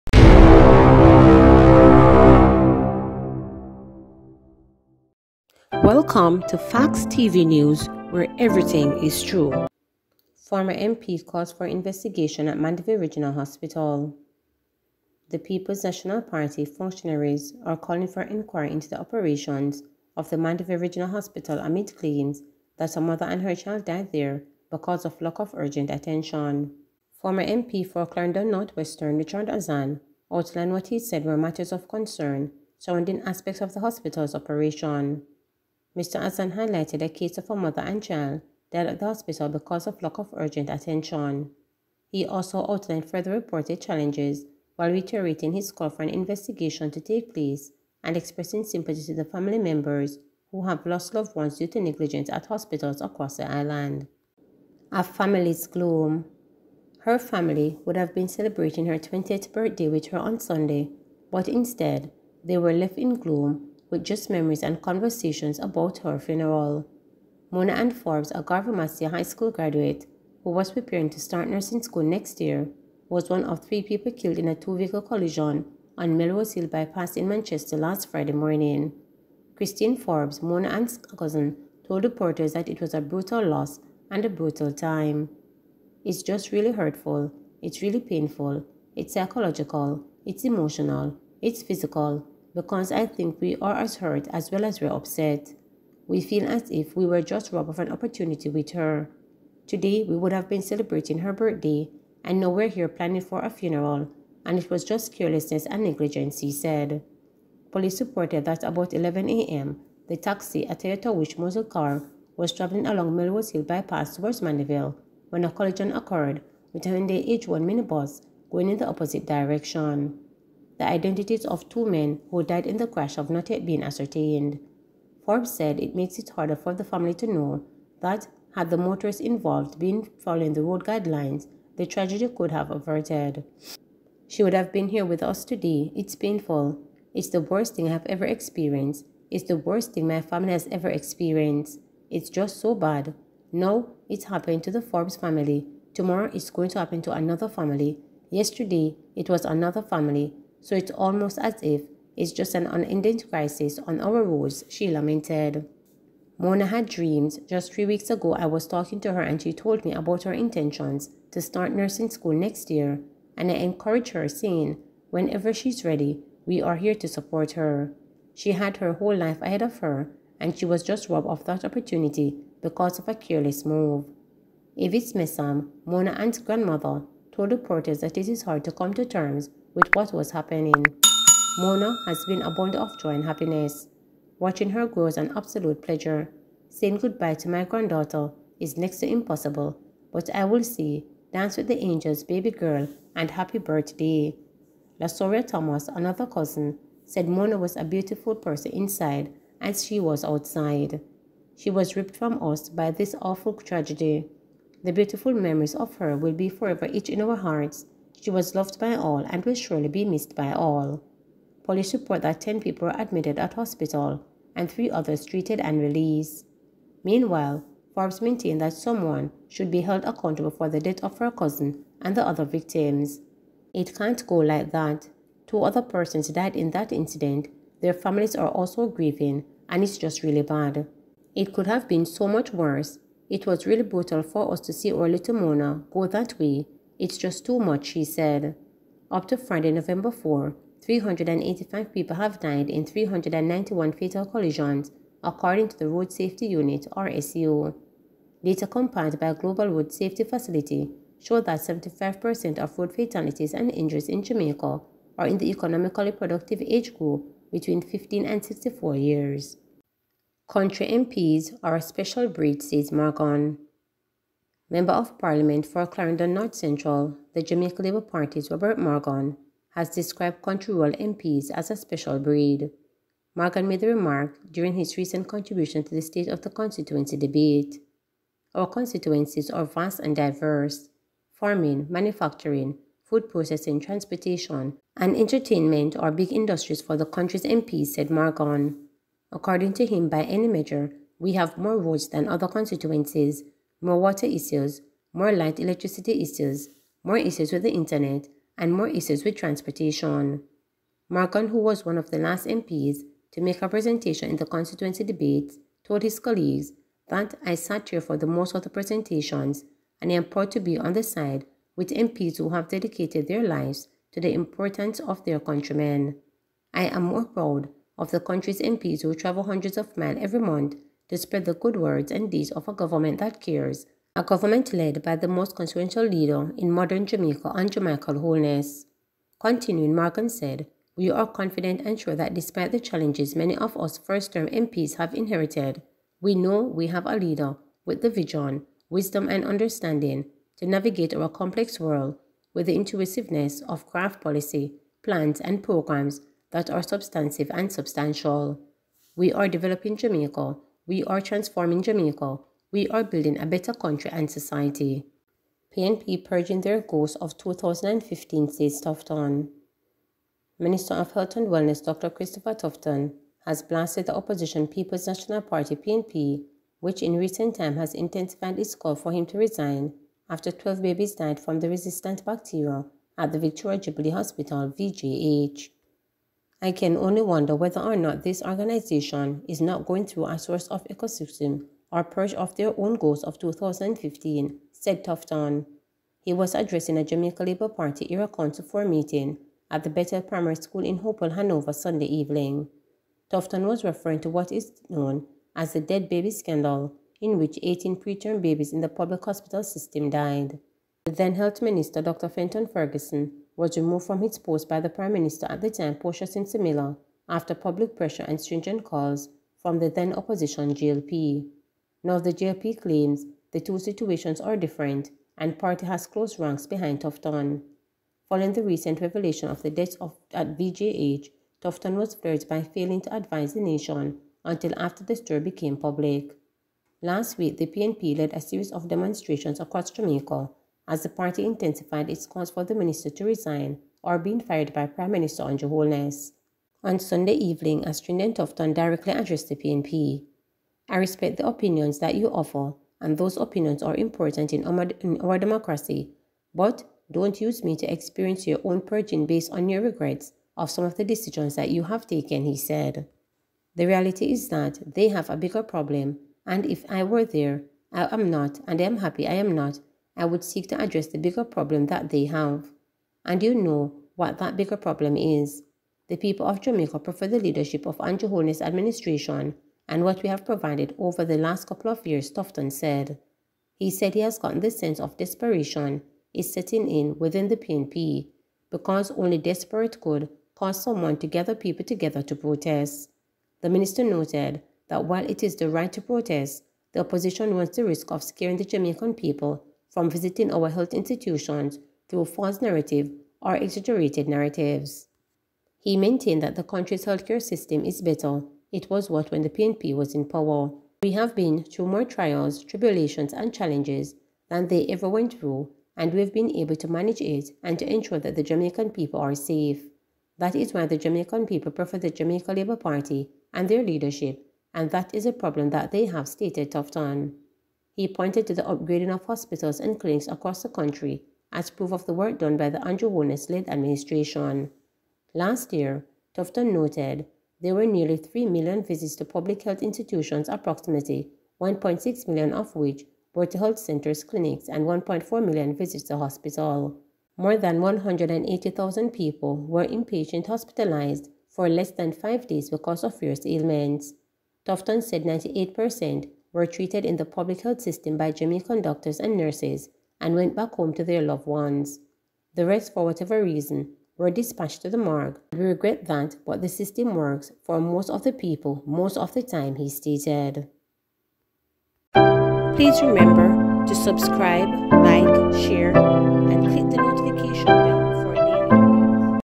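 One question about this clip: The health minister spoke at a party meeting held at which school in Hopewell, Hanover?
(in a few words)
Bethel Primary School.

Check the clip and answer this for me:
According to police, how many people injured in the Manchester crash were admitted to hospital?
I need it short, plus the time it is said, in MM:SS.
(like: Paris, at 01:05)
10, at 03:32.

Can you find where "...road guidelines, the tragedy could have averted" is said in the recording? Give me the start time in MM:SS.
02:10.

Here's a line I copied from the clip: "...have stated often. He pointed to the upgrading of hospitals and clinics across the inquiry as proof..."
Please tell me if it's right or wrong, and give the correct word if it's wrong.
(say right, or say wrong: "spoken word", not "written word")
wrong: "country", not "inquiry".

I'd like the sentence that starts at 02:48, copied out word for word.
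She had her whole life ahead of her, and she was just robbed of that opportunity because of a careless move.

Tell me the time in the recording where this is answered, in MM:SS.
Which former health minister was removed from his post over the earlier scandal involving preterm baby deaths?
06:42.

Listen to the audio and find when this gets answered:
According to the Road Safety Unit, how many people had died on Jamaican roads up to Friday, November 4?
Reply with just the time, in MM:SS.
04:00.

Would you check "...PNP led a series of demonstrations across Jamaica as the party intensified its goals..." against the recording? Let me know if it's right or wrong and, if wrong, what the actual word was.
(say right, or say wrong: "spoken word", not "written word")
wrong: "calls", not "goals".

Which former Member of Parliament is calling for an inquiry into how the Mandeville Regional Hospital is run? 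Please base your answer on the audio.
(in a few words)
Richard Azan.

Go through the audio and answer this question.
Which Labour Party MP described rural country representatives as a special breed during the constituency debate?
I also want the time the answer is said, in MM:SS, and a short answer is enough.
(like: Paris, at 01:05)
Robert Morgan, at 04:28.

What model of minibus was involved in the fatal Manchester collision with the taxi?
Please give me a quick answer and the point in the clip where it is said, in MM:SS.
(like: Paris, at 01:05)
Hyundai H1, at 01:56.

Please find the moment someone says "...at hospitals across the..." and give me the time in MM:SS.
00:52.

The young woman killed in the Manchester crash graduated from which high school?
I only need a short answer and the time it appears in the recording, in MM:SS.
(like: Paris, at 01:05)
Garvey Maceo High School, at 01:08.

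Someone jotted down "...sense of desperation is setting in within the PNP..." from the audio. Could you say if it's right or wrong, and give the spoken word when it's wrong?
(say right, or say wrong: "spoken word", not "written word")
right.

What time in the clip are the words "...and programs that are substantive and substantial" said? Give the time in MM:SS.
05:45.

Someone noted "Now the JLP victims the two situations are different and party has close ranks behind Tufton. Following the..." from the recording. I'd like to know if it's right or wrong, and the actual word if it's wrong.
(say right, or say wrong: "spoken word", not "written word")
wrong: "claims", not "victims".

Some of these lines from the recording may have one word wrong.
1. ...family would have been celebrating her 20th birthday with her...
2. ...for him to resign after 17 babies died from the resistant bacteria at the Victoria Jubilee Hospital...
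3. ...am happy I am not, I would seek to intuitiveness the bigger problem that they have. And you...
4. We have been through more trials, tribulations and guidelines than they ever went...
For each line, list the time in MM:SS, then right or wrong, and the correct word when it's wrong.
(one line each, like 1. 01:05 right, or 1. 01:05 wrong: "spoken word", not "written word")
1. 00:57 right
2. 06:08 wrong: "12", not "17"
3. 07:38 wrong: "address", not "intuitiveness"
4. 08:21 wrong: "challenges", not "guidelines".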